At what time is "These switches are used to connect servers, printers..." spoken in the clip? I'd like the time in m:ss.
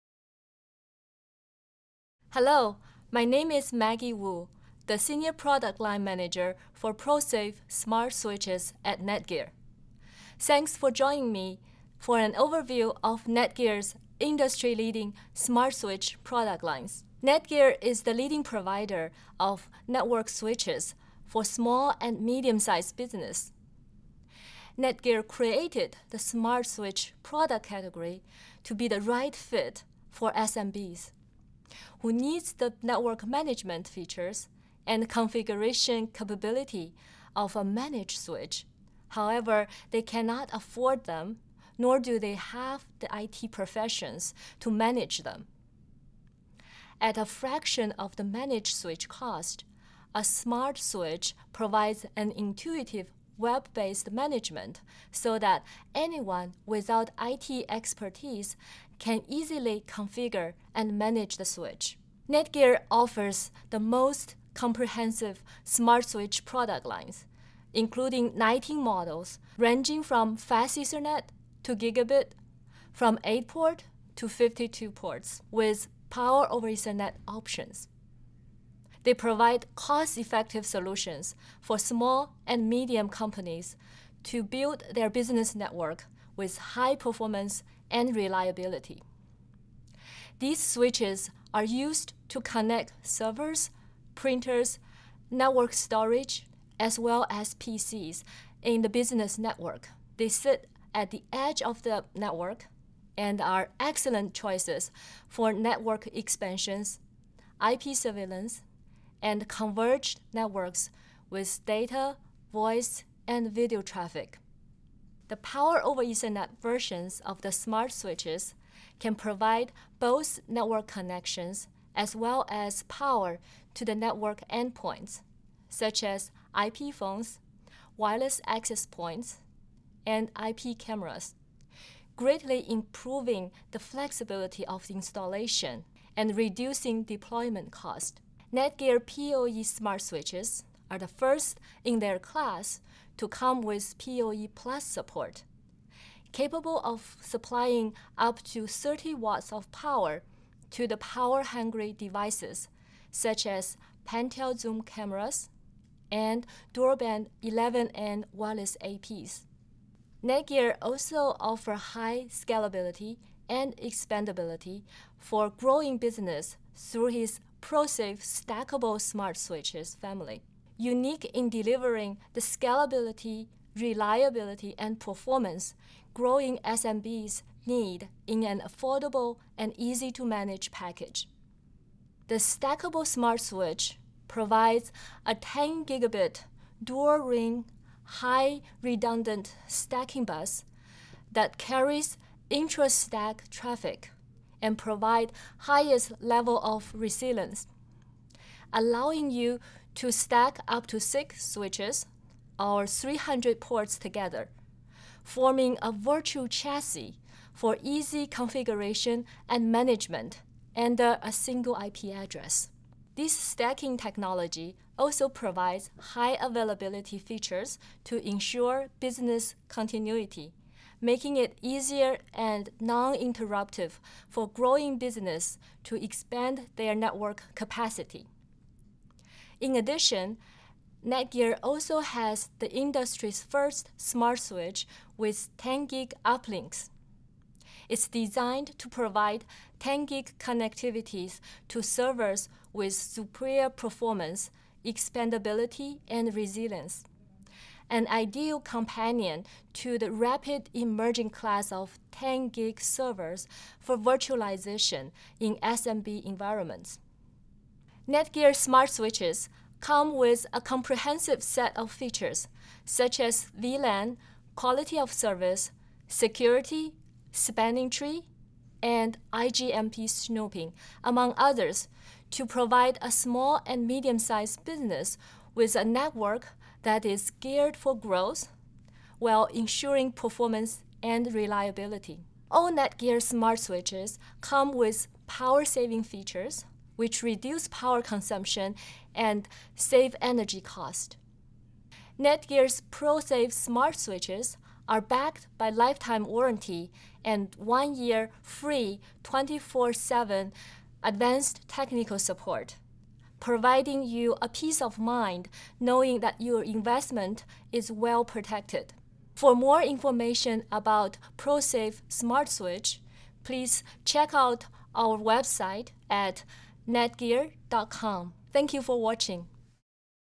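1:30.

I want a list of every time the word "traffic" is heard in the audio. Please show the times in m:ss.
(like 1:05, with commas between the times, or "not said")
1:53, 3:13.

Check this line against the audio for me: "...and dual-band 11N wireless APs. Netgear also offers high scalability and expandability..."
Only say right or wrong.
right.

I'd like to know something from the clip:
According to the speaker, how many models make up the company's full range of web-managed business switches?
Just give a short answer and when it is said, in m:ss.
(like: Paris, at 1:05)
19, at 1:08.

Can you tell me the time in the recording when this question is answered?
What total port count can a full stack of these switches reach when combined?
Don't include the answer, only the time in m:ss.
3:22.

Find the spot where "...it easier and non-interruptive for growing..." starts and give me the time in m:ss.
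3:41.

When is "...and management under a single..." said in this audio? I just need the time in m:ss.
3:29.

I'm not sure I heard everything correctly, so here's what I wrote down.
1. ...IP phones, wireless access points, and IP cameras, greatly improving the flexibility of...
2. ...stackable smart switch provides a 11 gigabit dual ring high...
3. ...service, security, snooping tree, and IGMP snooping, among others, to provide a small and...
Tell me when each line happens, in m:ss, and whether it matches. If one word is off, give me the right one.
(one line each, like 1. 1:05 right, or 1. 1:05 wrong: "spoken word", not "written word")
1. 2:06 right
2. 3:02 wrong: "10", not "11"
3. 4:25 wrong: "spanning", not "snooping".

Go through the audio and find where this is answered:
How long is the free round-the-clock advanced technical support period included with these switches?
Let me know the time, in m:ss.
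4:57.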